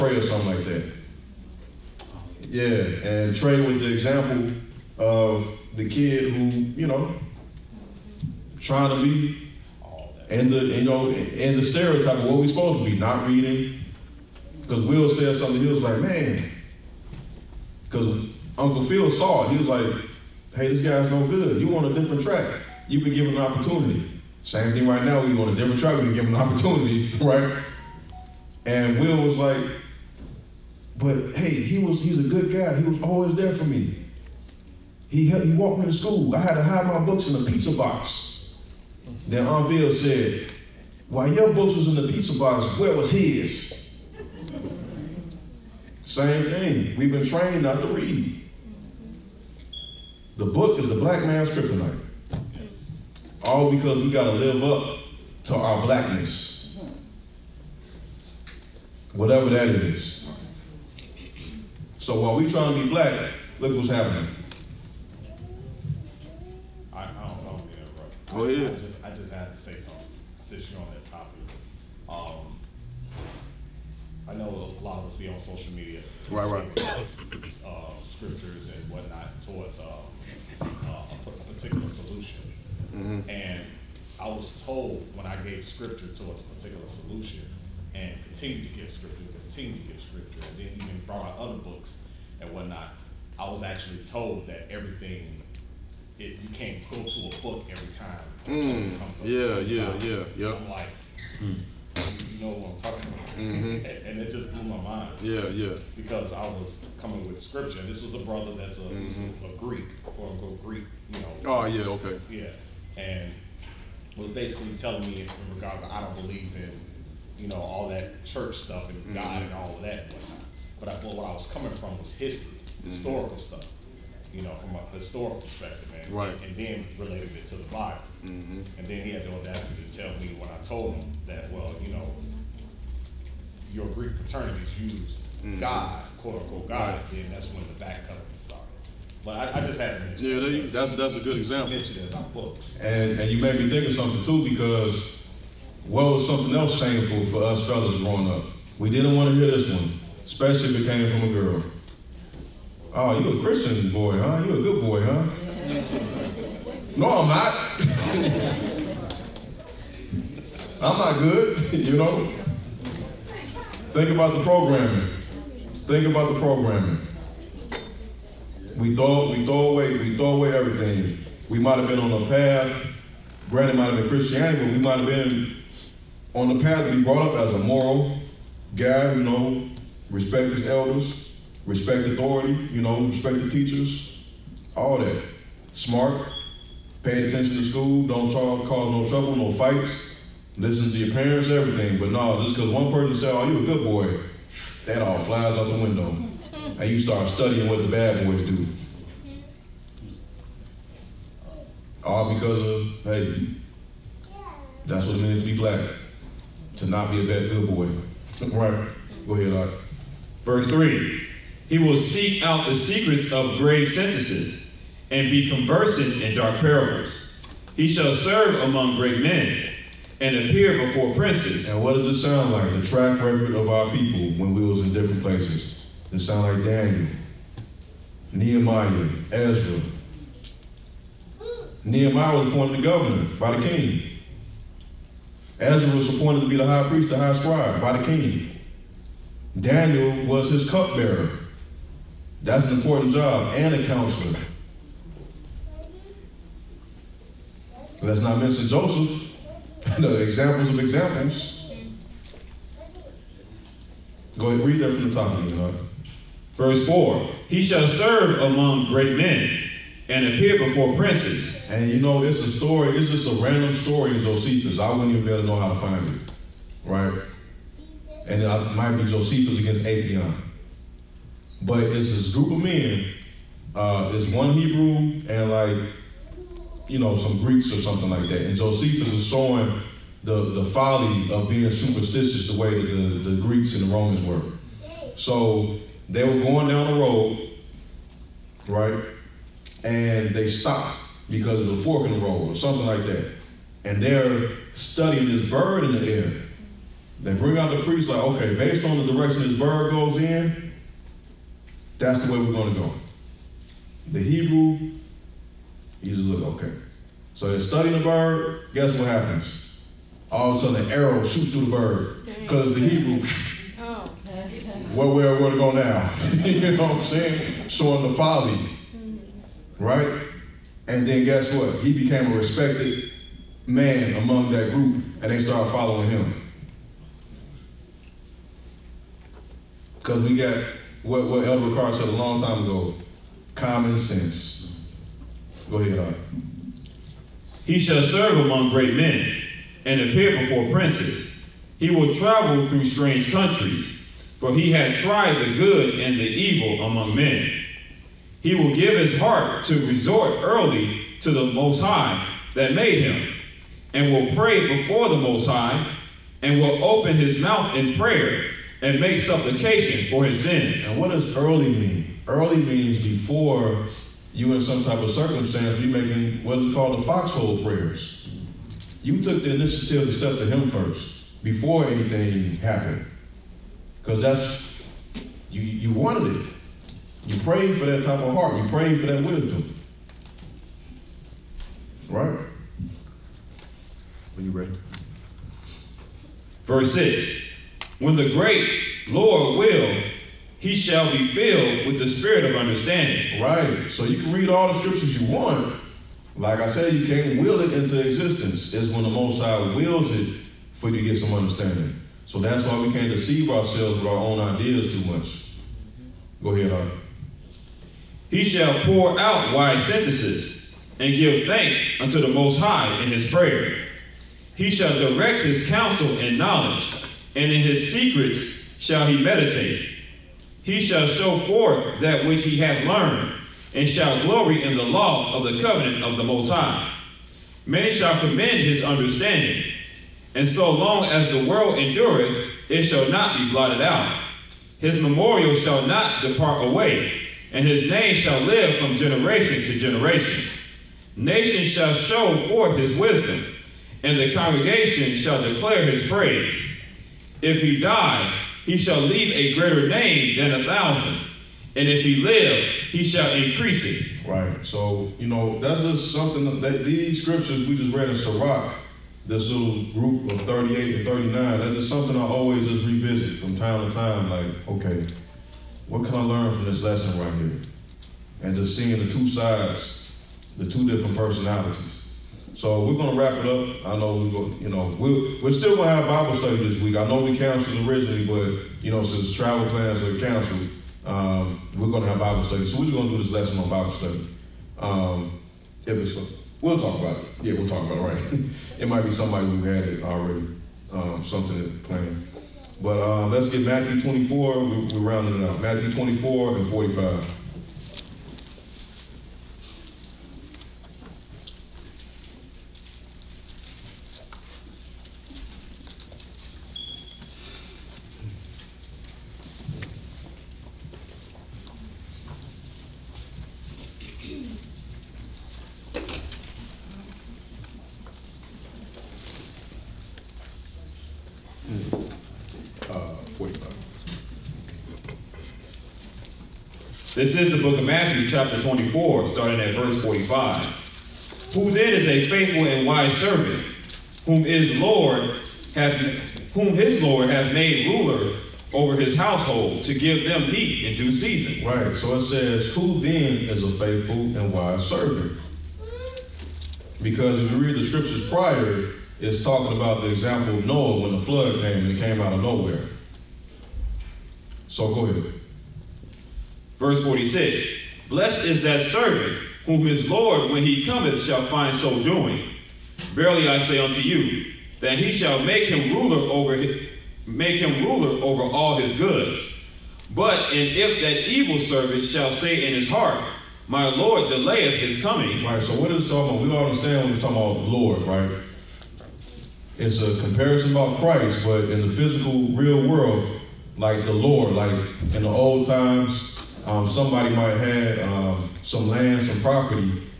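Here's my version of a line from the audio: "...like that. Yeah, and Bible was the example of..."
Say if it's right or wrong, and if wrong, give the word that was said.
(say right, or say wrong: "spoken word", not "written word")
wrong: "Trey", not "Bible".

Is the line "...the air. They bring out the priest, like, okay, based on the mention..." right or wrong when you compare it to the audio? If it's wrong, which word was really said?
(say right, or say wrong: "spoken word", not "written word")
wrong: "direction", not "mention".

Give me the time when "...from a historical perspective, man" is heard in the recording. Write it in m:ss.
2:04.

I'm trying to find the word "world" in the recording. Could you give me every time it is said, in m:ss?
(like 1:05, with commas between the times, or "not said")
7:11, 9:42.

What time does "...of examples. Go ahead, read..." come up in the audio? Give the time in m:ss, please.
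4:10.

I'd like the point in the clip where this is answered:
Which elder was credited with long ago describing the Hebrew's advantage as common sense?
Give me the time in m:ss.
5:31.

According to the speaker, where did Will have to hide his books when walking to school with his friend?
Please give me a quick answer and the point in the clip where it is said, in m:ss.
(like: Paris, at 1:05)
In a pizza box, at 0:37.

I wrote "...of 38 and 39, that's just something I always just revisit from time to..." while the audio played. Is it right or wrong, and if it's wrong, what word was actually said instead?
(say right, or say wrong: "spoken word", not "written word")
right.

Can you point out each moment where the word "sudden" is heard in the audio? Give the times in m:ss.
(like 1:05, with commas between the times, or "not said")
5:10.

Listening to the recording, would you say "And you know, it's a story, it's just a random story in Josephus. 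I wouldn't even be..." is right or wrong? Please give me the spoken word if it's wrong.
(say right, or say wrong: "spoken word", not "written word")
right.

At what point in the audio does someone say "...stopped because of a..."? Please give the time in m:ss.
4:50.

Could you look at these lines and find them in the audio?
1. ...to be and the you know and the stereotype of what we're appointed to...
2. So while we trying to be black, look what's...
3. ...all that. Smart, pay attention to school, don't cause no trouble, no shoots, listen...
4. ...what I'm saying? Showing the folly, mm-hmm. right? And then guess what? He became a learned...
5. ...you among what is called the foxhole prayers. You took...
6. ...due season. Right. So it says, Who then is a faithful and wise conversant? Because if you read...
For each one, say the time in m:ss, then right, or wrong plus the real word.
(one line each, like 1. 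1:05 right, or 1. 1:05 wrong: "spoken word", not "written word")
1. 0:08 wrong: "supposed", not "appointed"
2. 1:01 right
3. 3:04 wrong: "fights", not "shoots"
4. 5:16 wrong: "respected", not "learned"
5. 6:05 wrong: "making", not "among"
6. 9:00 wrong: "servant", not "conversant".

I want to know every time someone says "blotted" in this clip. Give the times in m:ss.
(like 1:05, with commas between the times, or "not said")
7:13.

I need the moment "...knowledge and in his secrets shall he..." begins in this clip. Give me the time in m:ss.
6:56.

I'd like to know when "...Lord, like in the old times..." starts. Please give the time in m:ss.
9:44.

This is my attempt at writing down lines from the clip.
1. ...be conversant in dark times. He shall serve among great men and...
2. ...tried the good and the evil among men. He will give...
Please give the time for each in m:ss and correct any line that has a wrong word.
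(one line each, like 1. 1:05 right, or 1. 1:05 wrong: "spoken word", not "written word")
1. 3:35 wrong: "parables", not "times"
2. 5:44 right.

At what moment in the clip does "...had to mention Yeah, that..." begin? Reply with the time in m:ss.
2:19.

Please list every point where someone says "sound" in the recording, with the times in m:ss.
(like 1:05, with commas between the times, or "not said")
3:42, 3:46.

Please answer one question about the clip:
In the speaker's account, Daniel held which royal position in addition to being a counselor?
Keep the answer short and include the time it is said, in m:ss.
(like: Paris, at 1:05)
Cupbearer, at 4:00.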